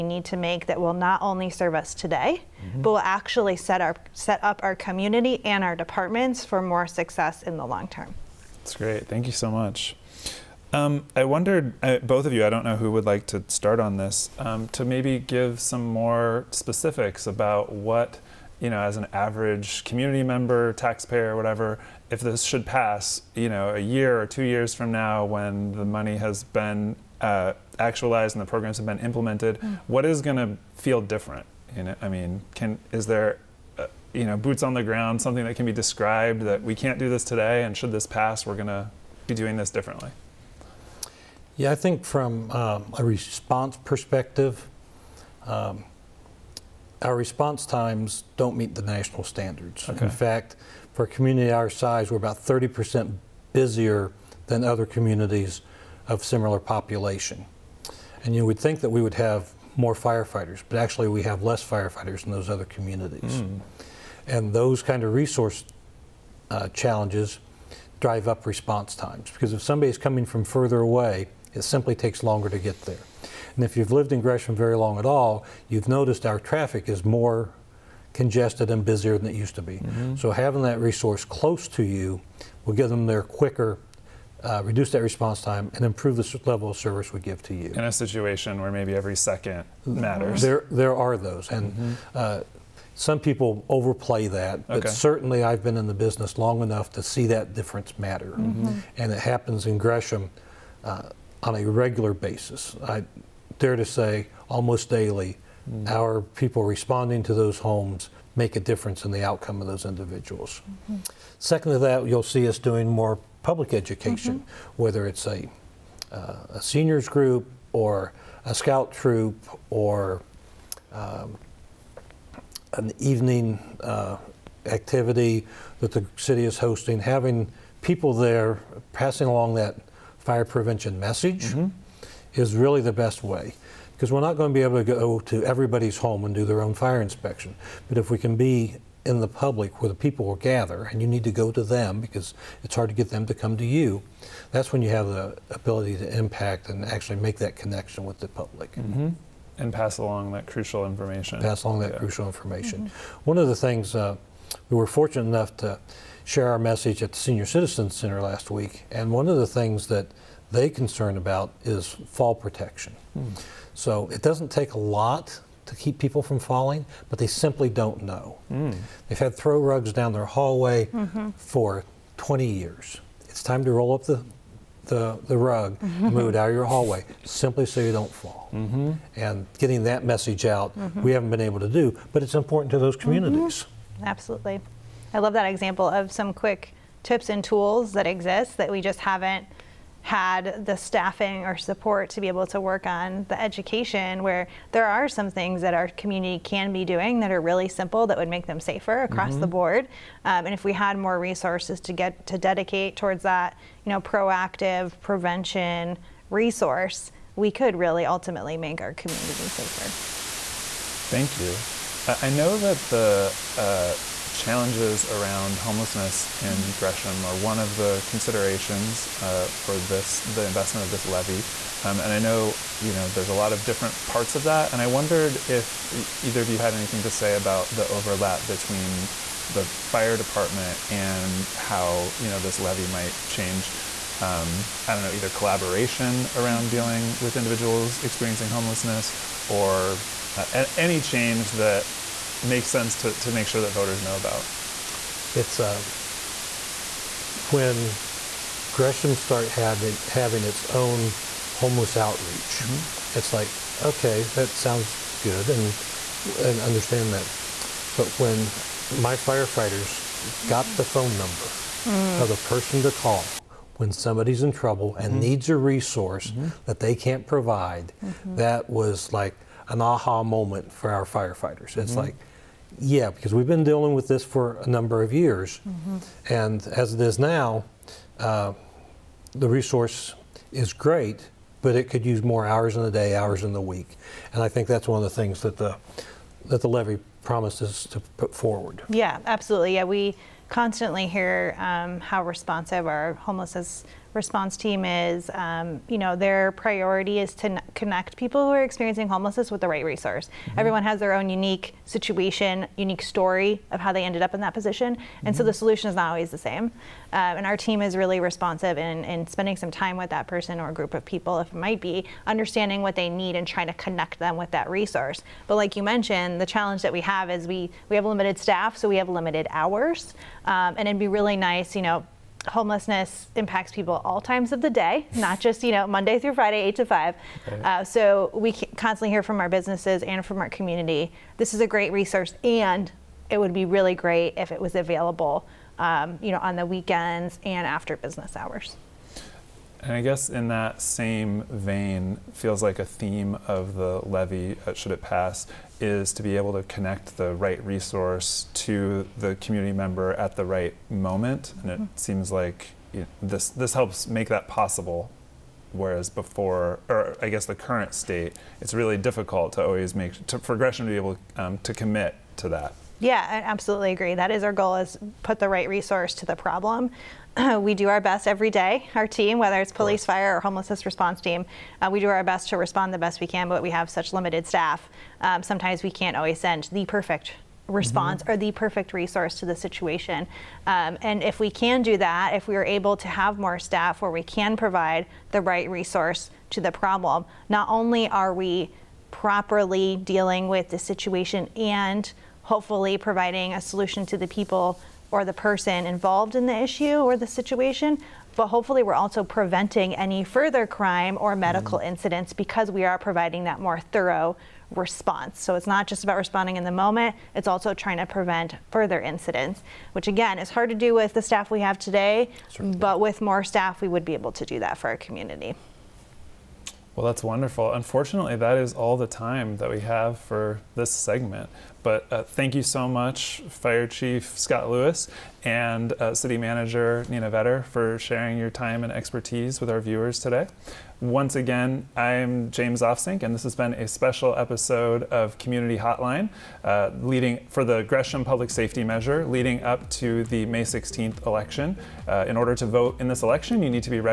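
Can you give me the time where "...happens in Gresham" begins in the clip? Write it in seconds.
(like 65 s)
99 s.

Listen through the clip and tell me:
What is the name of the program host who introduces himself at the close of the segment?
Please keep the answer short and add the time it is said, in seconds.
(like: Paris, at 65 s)
James Ofsink, at 432 s.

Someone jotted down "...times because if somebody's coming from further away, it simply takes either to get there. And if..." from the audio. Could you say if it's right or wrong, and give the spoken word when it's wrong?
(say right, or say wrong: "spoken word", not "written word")
wrong: "longer", not "either".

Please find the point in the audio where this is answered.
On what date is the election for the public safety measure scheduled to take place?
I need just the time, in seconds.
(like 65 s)
440 s.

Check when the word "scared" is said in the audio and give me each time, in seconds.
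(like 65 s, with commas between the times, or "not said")
not said.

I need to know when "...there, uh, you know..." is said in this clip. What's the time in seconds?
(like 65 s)
33 s.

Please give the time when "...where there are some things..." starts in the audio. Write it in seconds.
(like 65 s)
194 s.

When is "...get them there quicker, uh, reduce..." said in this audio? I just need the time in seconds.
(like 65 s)
82 s.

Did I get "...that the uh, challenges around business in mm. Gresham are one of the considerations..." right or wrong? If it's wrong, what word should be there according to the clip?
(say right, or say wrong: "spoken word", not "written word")
wrong: "homelessness", not "business".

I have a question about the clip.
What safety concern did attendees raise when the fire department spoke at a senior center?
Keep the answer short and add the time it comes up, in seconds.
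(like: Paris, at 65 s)
Fall protection, at 162 s.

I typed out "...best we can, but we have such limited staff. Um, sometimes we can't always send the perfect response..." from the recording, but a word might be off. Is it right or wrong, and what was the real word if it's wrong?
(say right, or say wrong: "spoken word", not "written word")
right.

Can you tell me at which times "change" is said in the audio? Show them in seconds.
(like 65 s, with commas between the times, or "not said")
233 s, 241 s.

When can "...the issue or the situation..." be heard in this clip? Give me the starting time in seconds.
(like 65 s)
396 s.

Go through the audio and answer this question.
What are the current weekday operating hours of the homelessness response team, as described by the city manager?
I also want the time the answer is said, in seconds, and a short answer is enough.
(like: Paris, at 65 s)
Eight to five, at 326 s.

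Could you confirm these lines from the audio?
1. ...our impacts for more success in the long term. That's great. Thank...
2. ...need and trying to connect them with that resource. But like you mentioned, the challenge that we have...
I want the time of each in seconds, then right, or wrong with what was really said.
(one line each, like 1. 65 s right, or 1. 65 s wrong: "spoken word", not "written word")
1. 5 s wrong: "departments", not "impacts"
2. 313 s right.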